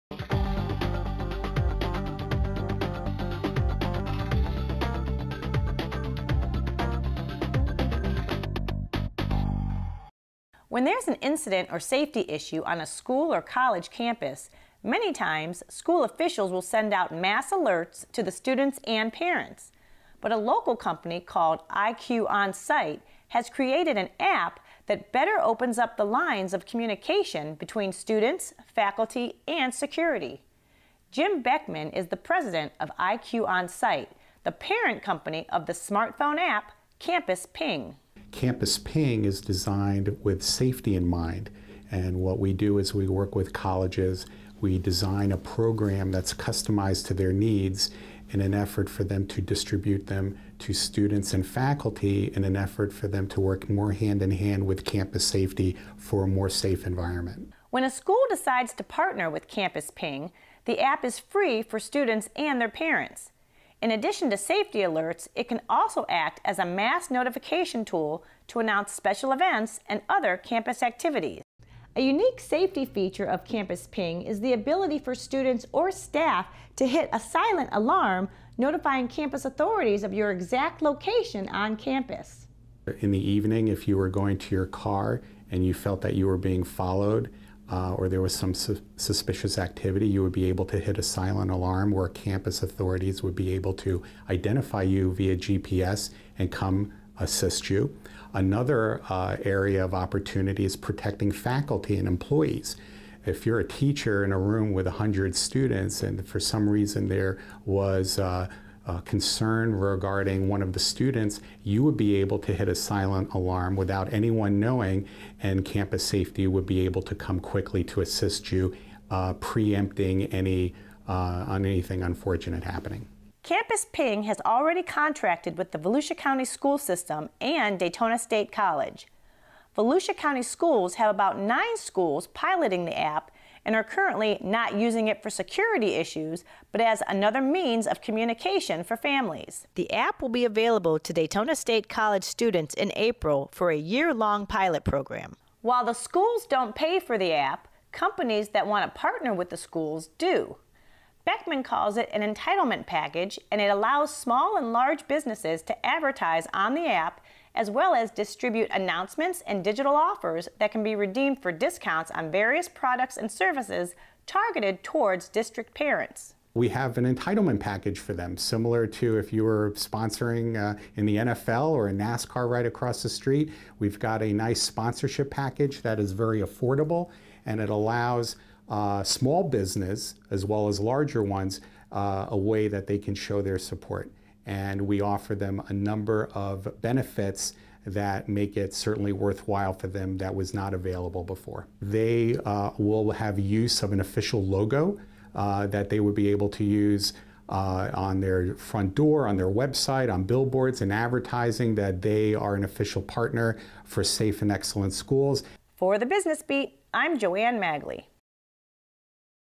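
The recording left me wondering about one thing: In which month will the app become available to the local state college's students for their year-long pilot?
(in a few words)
April.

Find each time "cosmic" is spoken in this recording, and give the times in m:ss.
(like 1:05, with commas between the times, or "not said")
not said.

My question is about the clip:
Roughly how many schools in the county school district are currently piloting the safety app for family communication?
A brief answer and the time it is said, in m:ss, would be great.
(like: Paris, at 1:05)
9, at 2:11.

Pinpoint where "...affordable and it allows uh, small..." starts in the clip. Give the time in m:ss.
2:56.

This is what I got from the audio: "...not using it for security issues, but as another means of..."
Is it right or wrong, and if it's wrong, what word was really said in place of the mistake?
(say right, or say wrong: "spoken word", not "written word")
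right.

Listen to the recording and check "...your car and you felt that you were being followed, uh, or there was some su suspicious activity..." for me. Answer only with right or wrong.
right.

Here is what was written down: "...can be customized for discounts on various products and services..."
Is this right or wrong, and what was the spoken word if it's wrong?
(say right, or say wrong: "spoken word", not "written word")
wrong: "redeemed", not "customized".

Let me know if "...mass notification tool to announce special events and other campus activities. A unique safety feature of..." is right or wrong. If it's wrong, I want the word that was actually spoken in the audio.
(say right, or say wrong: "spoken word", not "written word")
right.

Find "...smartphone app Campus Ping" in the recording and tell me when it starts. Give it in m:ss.
0:35.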